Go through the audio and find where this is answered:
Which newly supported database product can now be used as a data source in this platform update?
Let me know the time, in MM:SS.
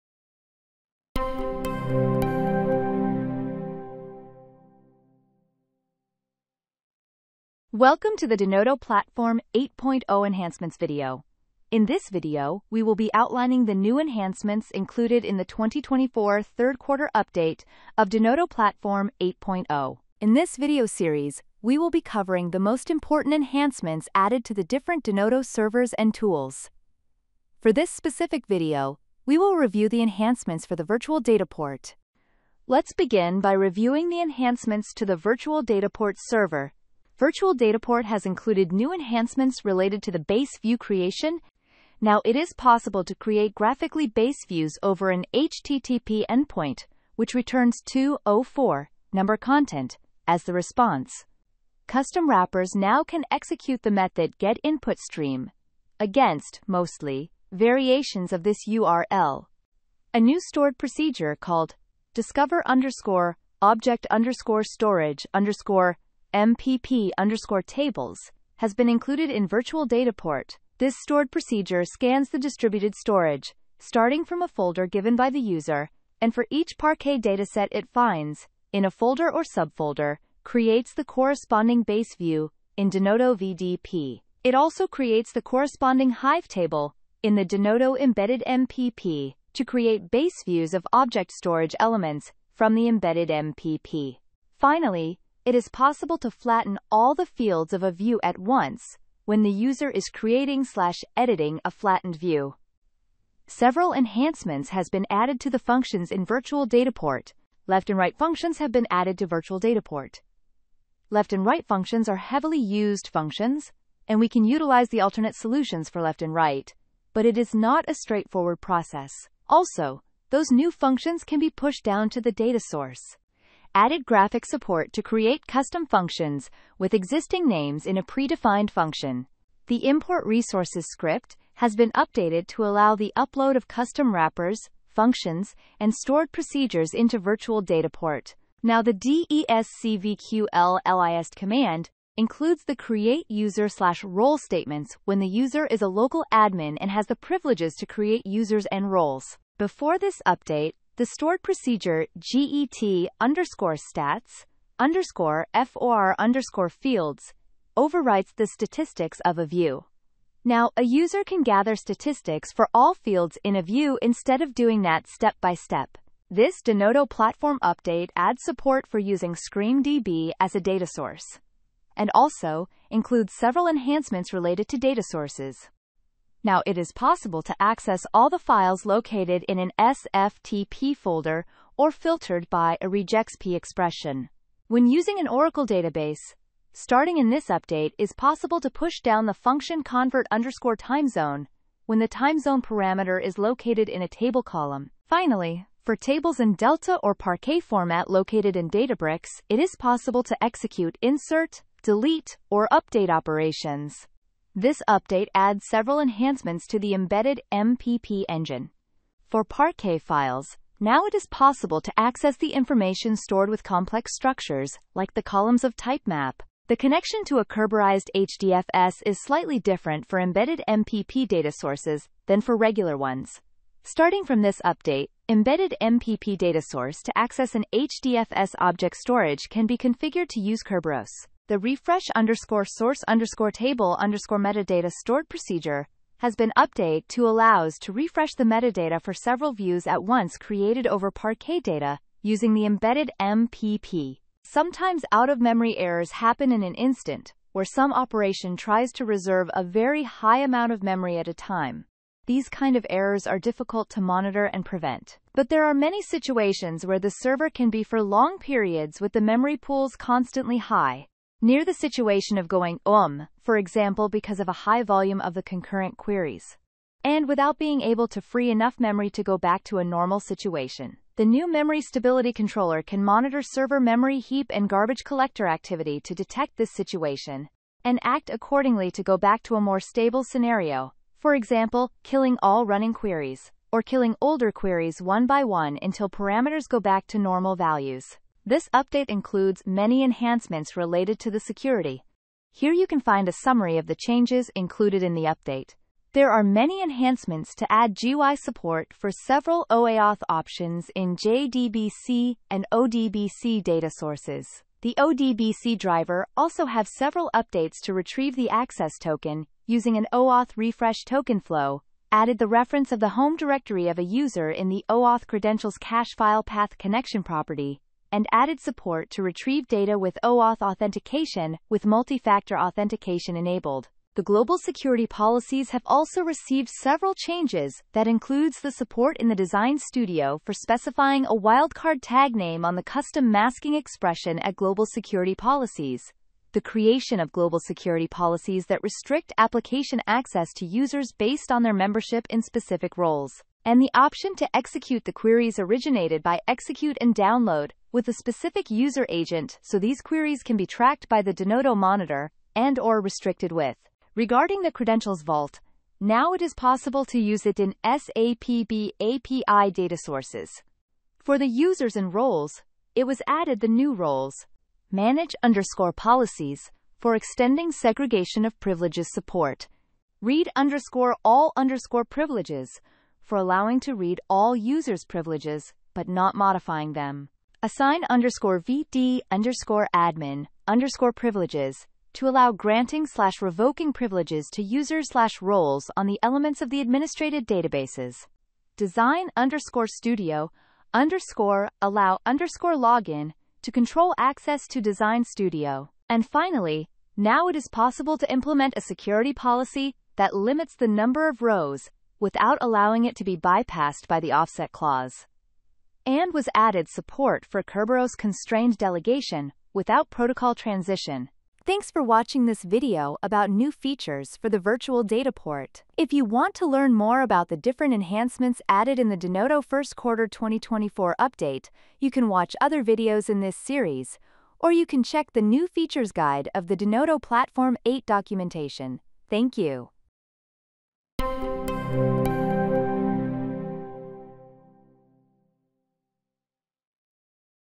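02:49.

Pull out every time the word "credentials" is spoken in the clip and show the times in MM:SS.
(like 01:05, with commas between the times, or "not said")
05:15, 05:54.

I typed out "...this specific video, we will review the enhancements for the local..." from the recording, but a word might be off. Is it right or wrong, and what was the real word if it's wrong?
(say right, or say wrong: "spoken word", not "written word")
wrong: "virtual", not "local".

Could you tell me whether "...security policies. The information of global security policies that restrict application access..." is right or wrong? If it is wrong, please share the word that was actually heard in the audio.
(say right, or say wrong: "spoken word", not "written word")
wrong: "creation", not "information".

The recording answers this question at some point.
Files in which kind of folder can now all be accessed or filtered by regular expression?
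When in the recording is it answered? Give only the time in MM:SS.
02:59.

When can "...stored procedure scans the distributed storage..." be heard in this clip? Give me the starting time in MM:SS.
01:10.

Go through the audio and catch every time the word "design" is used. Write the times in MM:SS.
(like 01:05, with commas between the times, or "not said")
05:29, 06:28, 06:34.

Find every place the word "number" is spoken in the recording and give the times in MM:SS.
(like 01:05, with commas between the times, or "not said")
00:49, 06:40.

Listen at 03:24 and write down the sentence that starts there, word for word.
This update adds several enhancements to the embedded MPP engine.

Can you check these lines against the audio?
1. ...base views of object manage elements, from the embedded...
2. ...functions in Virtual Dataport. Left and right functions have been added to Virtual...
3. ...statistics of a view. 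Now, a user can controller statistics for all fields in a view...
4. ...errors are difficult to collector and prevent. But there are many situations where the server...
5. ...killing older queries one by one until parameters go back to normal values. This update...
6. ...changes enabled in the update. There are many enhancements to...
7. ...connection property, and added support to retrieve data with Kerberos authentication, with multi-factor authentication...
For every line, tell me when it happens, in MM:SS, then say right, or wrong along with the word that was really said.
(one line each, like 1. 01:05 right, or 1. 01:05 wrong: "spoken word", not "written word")
1. 01:30 wrong: "storage", not "manage"
2. 01:45 right
3. 02:38 wrong: "gather", not "controller"
4. 04:12 wrong: "monitor", not "collector"
5. 04:43 right
6. 04:53 wrong: "included", not "enabled"
7. 05:16 wrong: "OAuth", not "Kerberos".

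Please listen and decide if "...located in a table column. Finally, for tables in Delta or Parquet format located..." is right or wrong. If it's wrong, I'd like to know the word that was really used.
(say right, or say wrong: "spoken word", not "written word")
right.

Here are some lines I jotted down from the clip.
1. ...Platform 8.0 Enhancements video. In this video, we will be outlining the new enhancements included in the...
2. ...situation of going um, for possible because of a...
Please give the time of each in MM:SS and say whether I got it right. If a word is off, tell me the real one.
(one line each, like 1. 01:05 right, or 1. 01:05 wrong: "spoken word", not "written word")
1. 00:08 right
2. 04:21 wrong: "example", not "possible".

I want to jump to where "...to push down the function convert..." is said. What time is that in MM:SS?
03:08.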